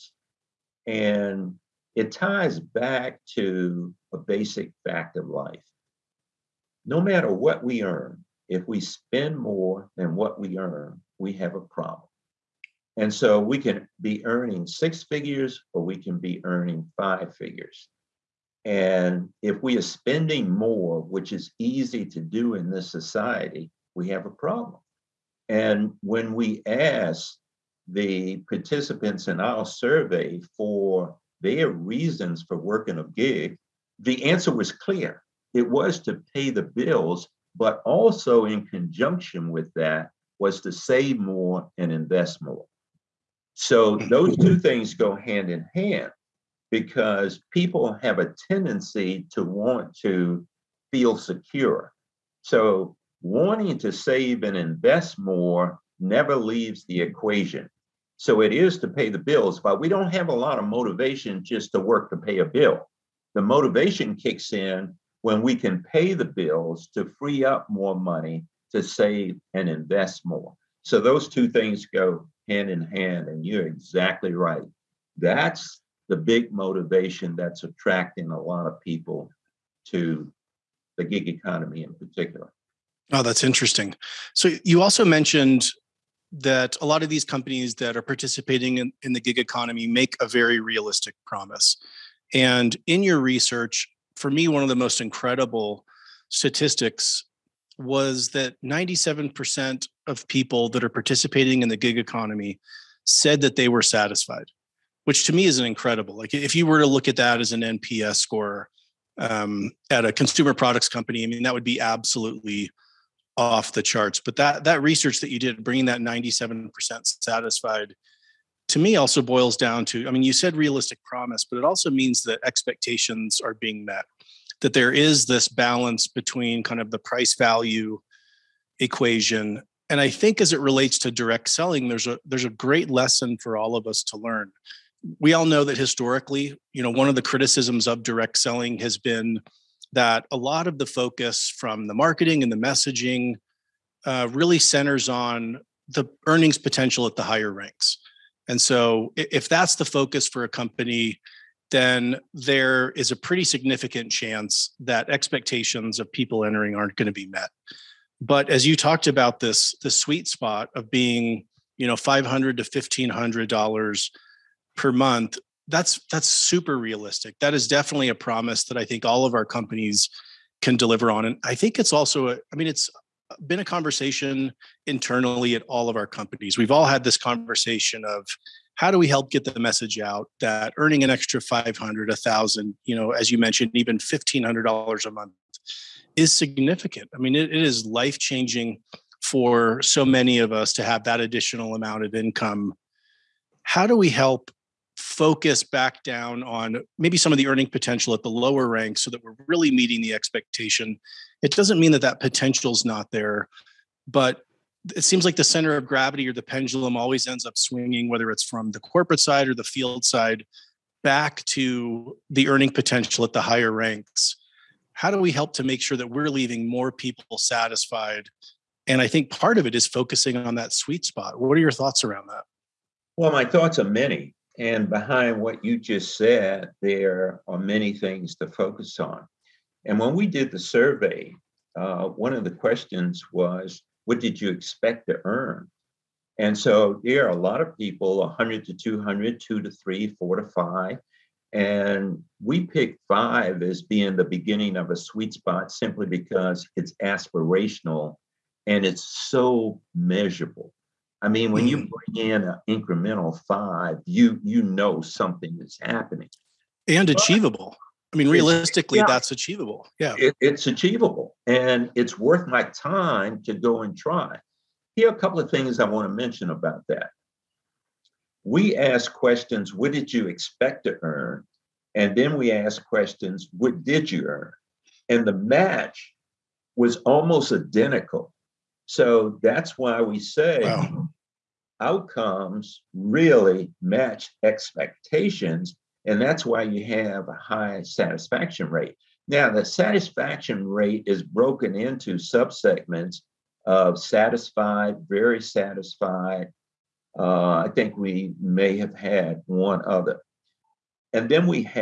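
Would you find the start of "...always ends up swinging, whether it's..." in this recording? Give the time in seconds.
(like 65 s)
206 s.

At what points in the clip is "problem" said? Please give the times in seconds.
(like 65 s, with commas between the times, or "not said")
11 s, 24 s.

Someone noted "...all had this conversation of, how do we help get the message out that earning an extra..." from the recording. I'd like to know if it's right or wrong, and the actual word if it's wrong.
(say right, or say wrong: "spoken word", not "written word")
right.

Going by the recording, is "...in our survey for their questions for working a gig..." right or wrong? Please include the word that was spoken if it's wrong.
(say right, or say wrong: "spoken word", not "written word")
wrong: "reasons", not "questions".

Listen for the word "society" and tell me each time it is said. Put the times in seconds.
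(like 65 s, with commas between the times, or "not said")
22 s.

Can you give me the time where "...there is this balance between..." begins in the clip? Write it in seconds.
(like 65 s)
124 s.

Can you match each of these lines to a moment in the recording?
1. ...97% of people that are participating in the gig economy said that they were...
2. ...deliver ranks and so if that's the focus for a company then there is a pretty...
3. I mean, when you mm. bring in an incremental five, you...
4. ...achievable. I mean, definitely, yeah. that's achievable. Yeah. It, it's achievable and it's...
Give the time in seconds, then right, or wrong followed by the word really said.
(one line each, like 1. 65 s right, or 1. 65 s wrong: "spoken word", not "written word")
1. 98 s right
2. 147 s wrong: "higher", not "deliver"
3. 251 s right
4. 257 s wrong: "realistically", not "definitely".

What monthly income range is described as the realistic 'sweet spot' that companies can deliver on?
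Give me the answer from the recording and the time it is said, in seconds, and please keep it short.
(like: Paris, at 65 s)
$500 to $1,500, at 161 s.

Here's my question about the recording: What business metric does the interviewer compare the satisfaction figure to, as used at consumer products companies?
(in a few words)
NPS score.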